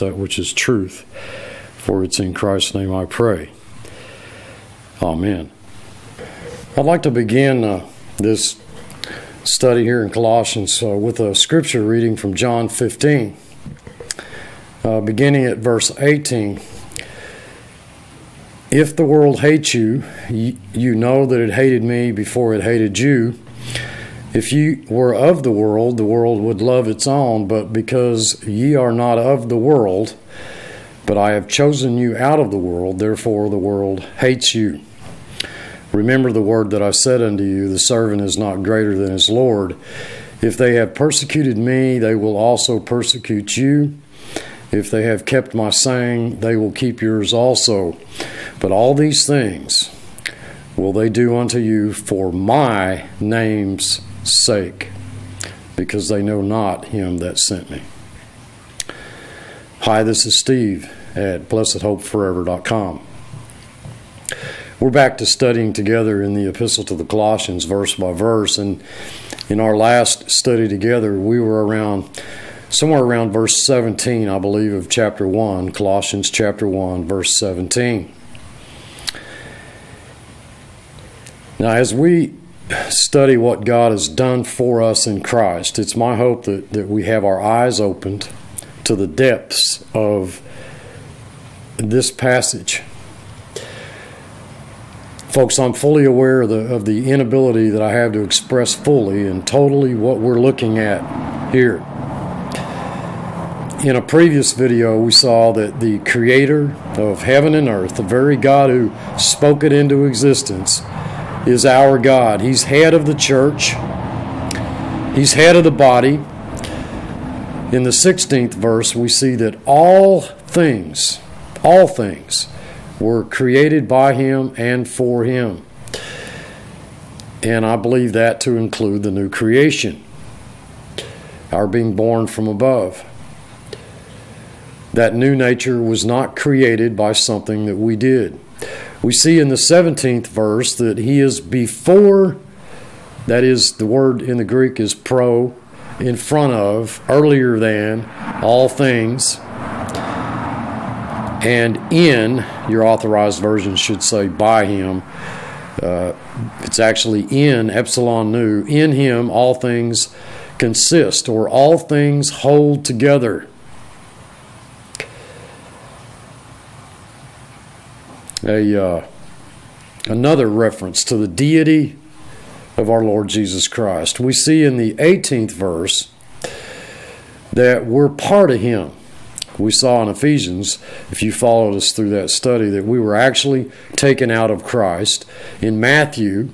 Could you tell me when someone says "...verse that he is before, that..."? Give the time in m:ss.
2:20.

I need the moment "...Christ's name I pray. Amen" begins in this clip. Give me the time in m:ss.
0:02.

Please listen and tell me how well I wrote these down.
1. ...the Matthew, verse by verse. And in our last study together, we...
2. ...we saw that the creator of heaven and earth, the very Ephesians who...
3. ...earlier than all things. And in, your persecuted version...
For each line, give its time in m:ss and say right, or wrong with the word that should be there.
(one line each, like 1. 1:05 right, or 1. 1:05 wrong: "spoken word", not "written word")
1. 1:06 wrong: "Colossians", not "Matthew"
2. 1:44 wrong: "God", not "Ephesians"
3. 2:27 wrong: "authorized", not "persecuted".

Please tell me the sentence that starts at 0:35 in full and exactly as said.
Remember the word that I said unto you the servant is not greater than his Lord.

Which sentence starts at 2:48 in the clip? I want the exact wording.
a uh, another reference to the deity of our Lord Jesus Christ.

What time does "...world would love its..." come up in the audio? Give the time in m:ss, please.
0:26.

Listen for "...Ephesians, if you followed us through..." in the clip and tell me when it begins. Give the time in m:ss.
3:00.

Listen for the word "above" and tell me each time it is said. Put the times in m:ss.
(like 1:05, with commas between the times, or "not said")
2:12.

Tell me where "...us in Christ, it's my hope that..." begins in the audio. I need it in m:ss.
1:24.